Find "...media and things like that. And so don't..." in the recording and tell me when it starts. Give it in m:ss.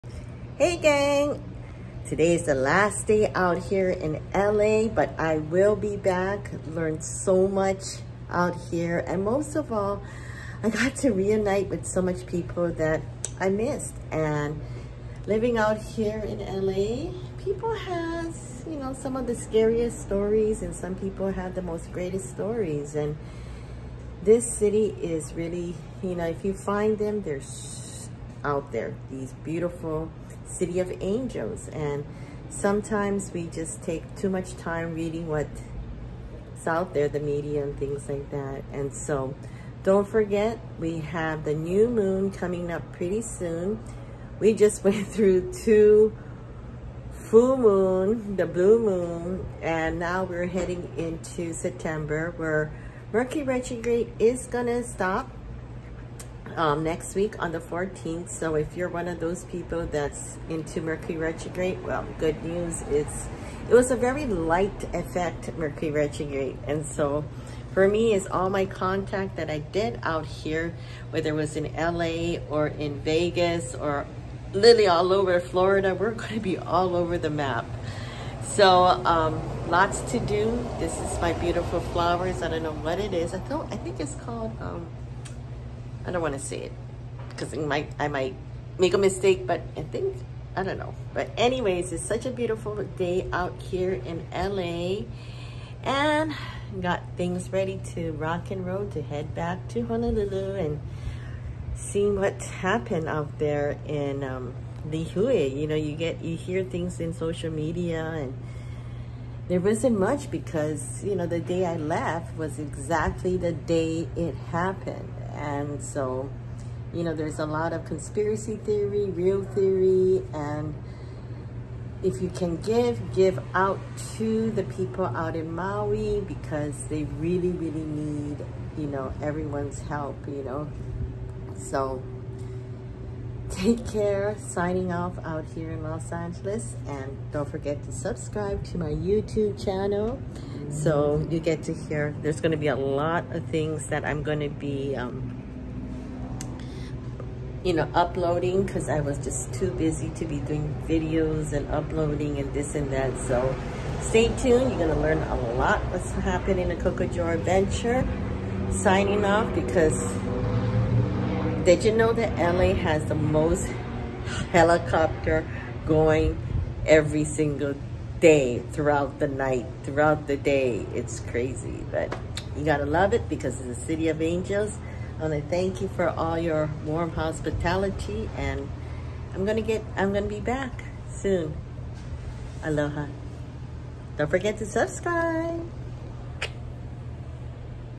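0:37.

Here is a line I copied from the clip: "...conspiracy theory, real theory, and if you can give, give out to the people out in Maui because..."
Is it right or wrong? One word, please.
right.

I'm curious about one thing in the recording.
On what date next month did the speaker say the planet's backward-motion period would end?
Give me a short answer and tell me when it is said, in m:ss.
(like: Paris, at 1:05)
14th, at 0:57.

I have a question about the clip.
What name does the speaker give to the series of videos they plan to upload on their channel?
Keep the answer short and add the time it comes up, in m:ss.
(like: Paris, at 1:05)
Cocojor Adventure, at 2:36.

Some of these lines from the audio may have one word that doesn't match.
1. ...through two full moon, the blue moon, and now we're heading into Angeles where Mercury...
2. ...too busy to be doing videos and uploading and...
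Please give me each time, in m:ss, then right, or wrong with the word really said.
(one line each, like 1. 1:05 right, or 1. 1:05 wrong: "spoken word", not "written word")
1. 0:45 wrong: "September", not "Angeles"
2. 2:29 right.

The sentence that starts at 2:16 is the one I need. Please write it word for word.
And don't forget to subscribe to my YouTube channel so you get to hear.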